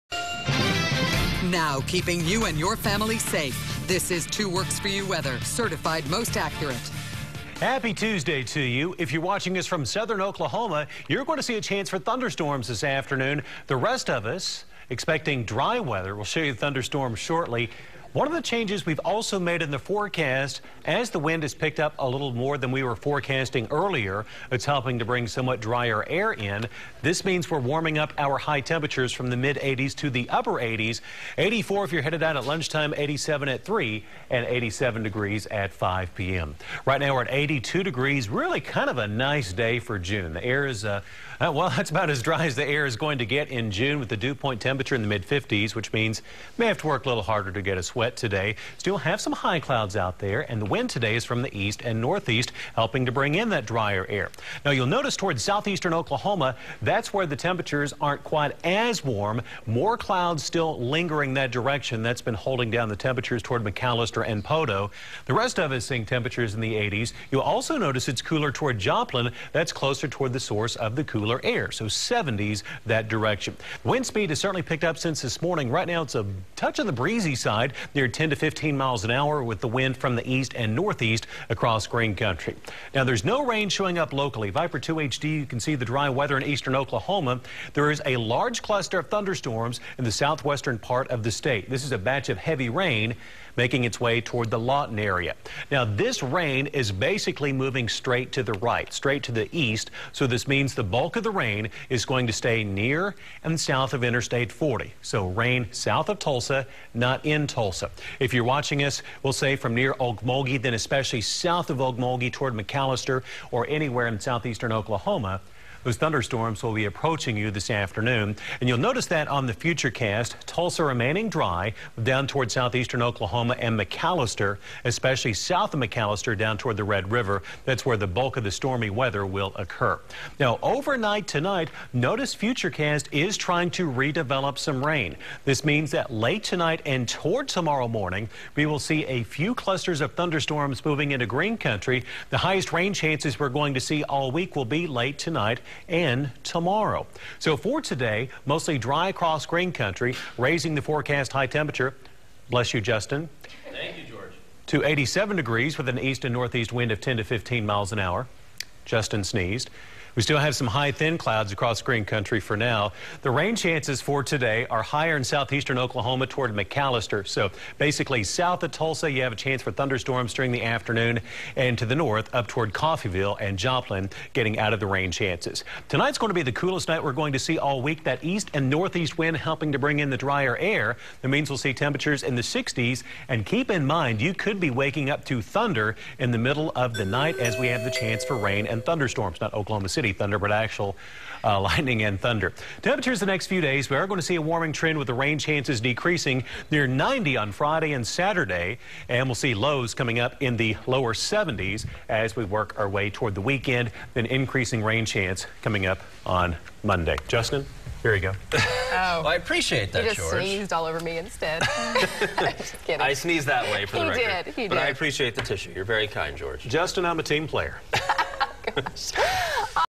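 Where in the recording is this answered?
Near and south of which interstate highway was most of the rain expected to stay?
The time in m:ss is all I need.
1:44.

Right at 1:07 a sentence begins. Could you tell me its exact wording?
You'll also notice it's cooler toward Joplin.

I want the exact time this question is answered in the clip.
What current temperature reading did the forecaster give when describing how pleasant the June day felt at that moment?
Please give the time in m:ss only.
0:37.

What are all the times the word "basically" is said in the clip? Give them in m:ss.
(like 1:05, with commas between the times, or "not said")
1:36, 2:47.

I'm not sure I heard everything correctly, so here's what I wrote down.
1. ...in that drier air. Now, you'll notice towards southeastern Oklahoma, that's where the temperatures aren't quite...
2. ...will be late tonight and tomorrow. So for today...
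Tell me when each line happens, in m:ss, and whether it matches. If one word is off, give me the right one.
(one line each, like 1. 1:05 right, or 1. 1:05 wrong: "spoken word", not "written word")
1. 0:53 right
2. 2:24 right.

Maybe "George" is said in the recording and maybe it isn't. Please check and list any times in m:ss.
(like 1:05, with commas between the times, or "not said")
2:34, 3:30, 3:36.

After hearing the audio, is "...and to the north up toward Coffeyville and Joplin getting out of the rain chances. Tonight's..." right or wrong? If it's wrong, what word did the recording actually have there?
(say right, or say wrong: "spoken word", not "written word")
right.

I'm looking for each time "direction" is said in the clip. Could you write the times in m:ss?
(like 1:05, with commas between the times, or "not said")
1:01, 1:13.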